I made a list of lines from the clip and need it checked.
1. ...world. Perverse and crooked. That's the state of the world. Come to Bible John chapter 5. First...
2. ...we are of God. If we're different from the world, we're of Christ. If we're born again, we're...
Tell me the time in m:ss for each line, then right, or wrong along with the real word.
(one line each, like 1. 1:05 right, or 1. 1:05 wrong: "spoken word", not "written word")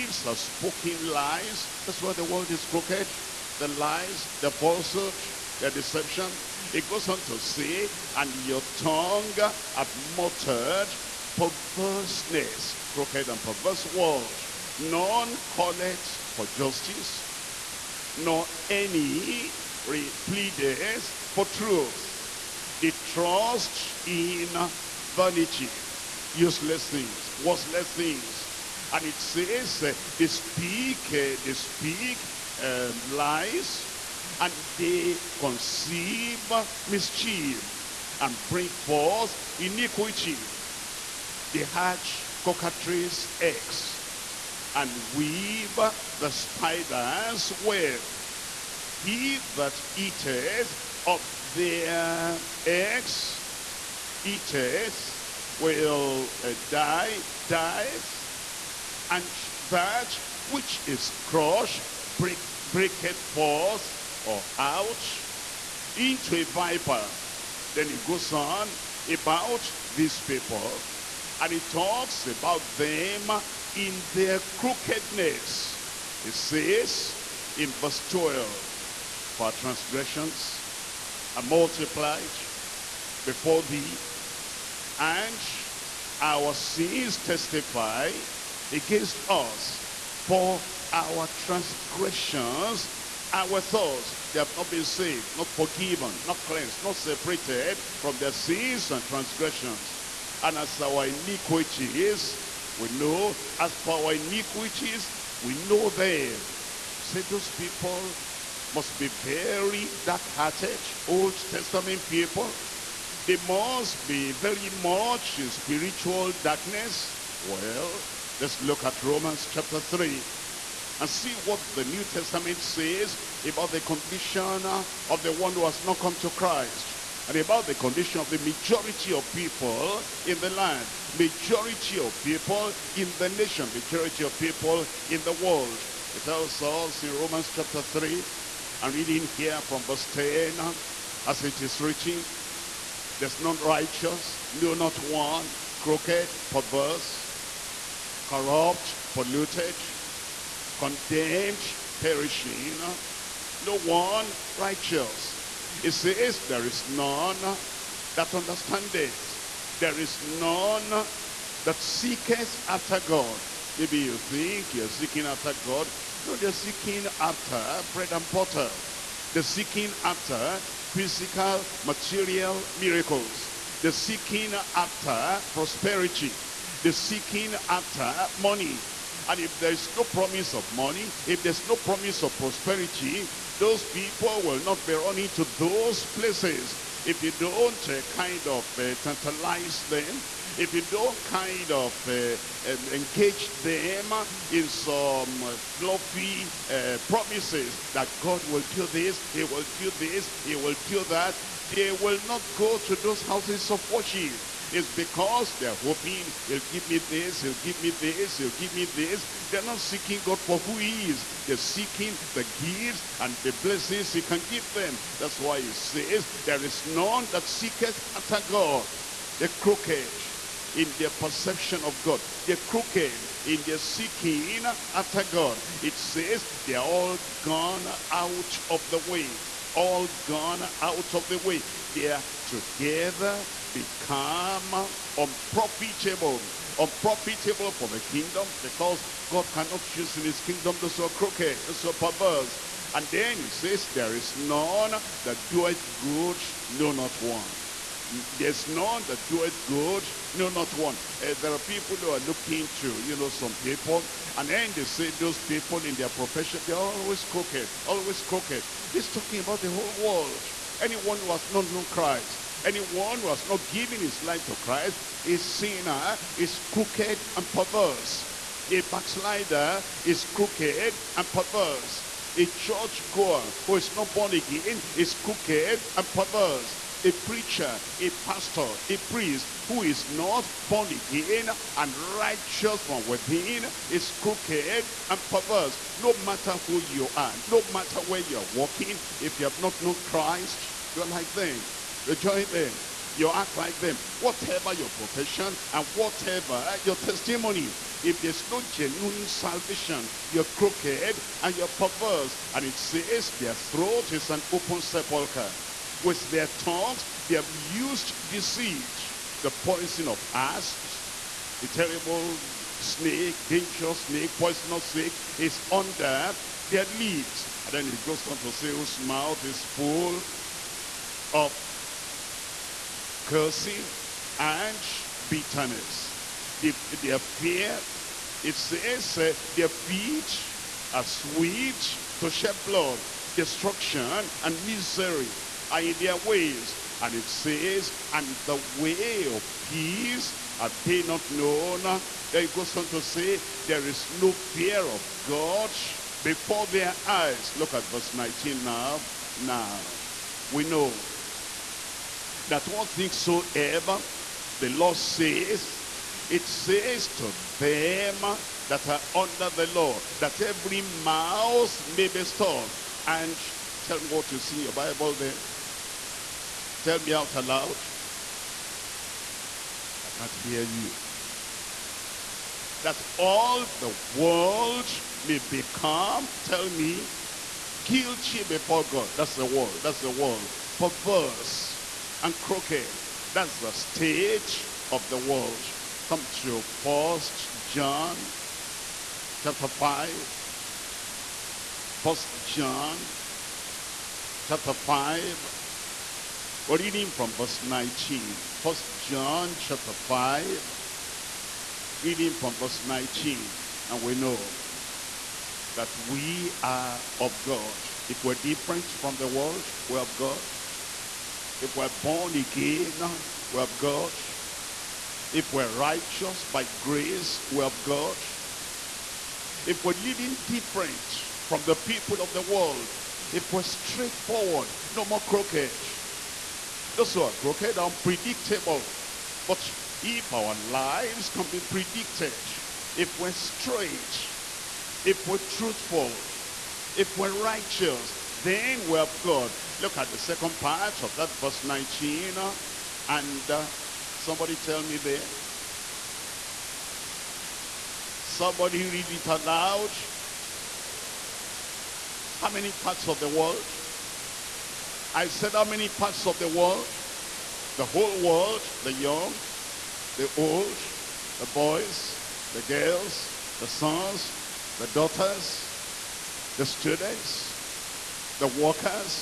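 1. 6:20 wrong: "First", not "Bible"
2. 6:45 wrong: "God", not "Christ".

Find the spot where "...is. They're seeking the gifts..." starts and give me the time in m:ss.
3:31.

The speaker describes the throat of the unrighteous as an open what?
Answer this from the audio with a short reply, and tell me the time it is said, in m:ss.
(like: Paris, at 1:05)
Sepulcher, at 5:04.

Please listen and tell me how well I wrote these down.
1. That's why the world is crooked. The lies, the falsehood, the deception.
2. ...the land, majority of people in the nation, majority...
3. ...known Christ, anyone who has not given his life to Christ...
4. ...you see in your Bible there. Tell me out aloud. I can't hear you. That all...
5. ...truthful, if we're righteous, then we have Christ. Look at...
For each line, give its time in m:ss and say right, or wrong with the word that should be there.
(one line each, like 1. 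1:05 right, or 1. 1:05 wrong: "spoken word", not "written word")
1. 0:01 right
2. 2:10 right
3. 4:21 right
4. 6:04 right
5. 7:15 wrong: "God", not "Christ".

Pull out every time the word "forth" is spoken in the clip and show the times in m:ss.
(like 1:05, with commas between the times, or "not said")
0:38, 1:03.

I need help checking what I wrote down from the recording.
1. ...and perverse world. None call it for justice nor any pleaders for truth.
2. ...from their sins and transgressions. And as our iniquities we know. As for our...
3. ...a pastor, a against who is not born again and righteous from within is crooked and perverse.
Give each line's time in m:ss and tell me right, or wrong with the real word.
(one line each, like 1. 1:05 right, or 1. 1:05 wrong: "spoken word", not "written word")
1. 0:13 right
2. 1:38 right
3. 4:37 wrong: "priest", not "against".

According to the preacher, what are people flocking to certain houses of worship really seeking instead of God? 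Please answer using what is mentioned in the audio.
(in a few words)
Bread and butter.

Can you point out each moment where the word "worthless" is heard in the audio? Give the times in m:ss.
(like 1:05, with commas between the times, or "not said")
0:27.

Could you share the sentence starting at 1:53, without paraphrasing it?
They must be very much in spiritual darkness.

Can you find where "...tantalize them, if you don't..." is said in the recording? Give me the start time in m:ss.
3:08.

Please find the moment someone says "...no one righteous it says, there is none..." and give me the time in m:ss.
2:33.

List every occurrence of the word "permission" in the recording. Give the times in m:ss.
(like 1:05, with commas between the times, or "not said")
not said.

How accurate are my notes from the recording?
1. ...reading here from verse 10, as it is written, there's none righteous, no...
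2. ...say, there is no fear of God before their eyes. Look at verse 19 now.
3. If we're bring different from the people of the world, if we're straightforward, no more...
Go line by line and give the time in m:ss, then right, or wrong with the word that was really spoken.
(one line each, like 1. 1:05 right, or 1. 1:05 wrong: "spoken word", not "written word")
1. 2:18 right
2. 5:43 right
3. 6:59 wrong: "living", not "bring".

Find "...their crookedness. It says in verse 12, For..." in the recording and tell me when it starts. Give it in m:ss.
1:14.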